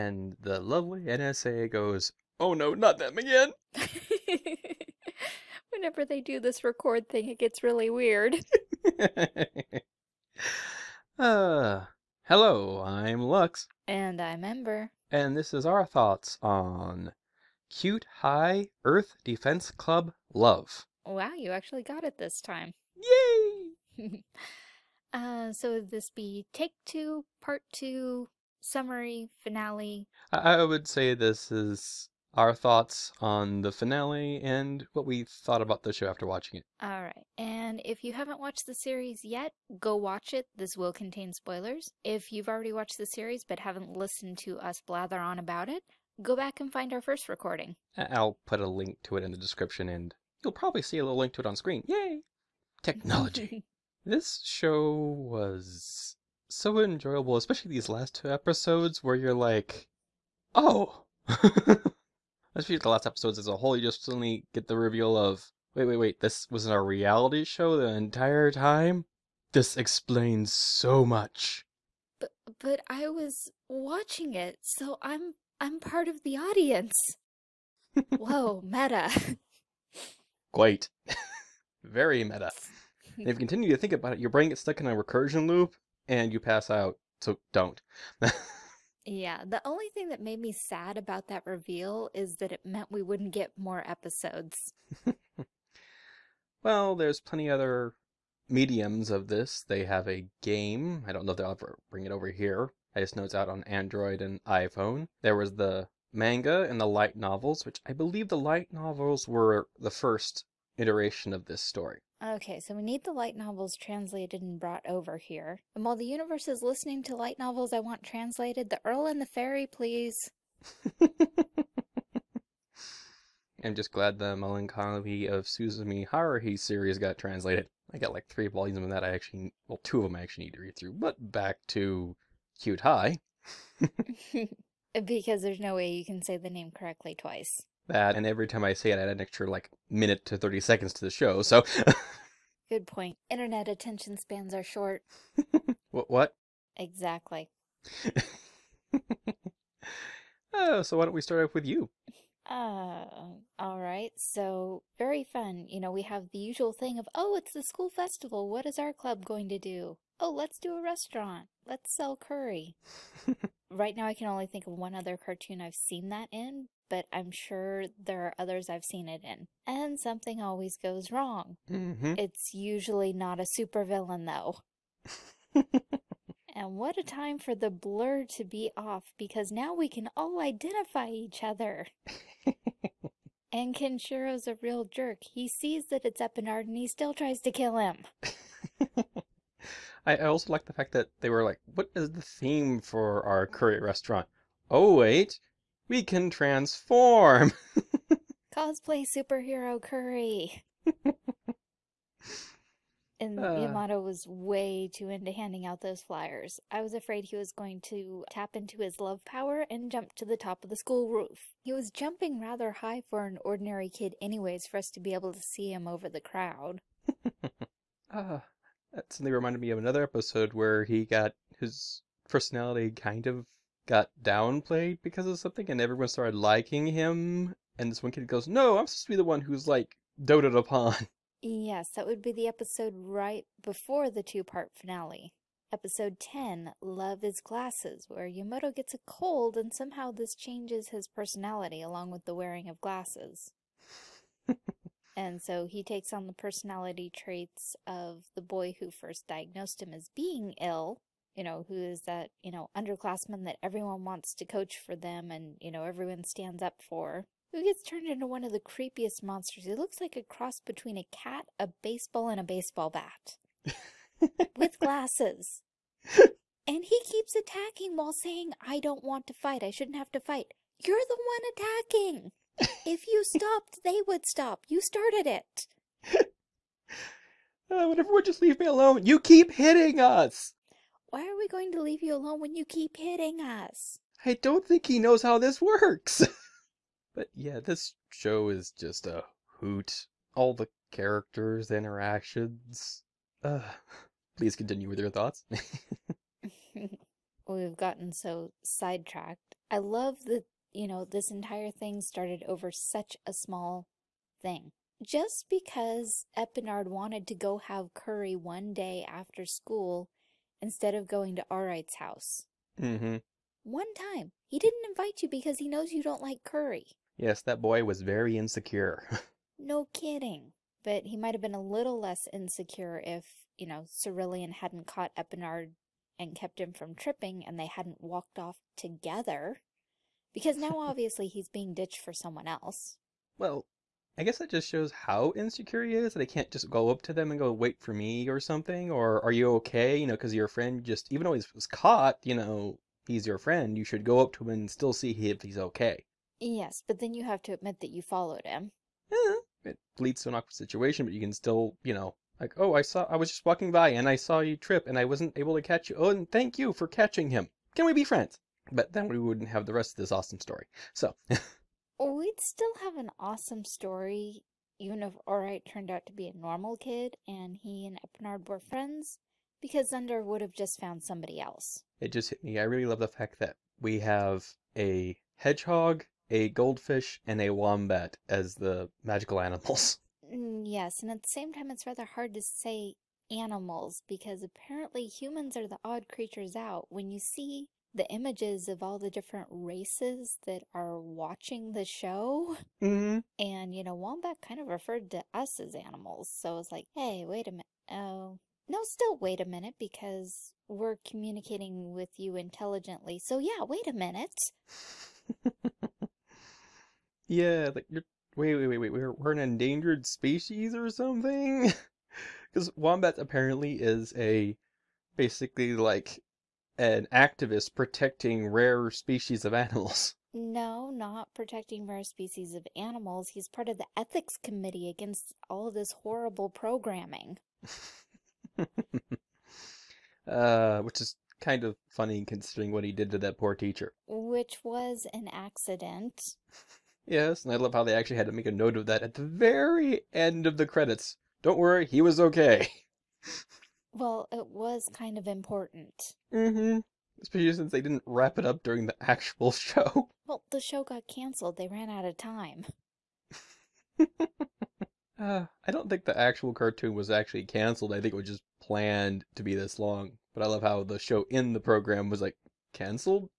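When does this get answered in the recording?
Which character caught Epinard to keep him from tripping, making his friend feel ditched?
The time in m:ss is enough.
5:24.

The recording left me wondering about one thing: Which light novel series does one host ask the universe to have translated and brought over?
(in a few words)
The Earl and the Fairy.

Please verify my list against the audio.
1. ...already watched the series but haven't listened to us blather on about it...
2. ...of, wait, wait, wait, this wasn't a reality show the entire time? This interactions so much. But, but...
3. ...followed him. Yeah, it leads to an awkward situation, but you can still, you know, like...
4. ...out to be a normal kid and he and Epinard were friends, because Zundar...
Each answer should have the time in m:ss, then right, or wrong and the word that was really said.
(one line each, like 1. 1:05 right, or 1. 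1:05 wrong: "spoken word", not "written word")
1. 0:42 right
2. 1:05 wrong: "explains", not "interactions"
3. 5:48 right
4. 6:05 right.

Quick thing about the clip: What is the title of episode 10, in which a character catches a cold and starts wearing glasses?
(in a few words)
Love is Glasses.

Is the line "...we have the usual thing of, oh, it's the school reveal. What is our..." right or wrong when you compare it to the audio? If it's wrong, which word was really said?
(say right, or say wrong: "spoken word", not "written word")
wrong: "festival", not "reveal".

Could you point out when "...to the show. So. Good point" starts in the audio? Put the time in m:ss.
2:20.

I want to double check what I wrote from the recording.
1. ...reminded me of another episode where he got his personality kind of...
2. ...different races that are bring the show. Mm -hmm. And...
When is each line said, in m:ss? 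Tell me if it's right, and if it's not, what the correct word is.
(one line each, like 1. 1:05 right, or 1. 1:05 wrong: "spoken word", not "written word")
1. 3:39 right
2. 6:29 wrong: "watching", not "bring".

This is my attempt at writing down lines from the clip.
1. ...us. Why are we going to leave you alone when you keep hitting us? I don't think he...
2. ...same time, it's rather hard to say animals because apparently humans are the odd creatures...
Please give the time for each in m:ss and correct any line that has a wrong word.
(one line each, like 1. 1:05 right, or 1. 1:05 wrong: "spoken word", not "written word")
1. 4:40 right
2. 6:21 right.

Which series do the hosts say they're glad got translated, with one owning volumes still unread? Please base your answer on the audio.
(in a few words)
The Melancholy of Suzumiya Haruhi.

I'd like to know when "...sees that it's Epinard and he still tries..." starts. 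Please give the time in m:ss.
3:05.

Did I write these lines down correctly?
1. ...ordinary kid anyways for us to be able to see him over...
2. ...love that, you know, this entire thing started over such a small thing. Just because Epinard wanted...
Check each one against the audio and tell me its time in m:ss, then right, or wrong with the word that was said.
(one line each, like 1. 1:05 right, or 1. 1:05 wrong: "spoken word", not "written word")
1. 3:33 right
2. 4:59 right.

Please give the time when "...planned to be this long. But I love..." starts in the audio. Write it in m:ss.
7:38.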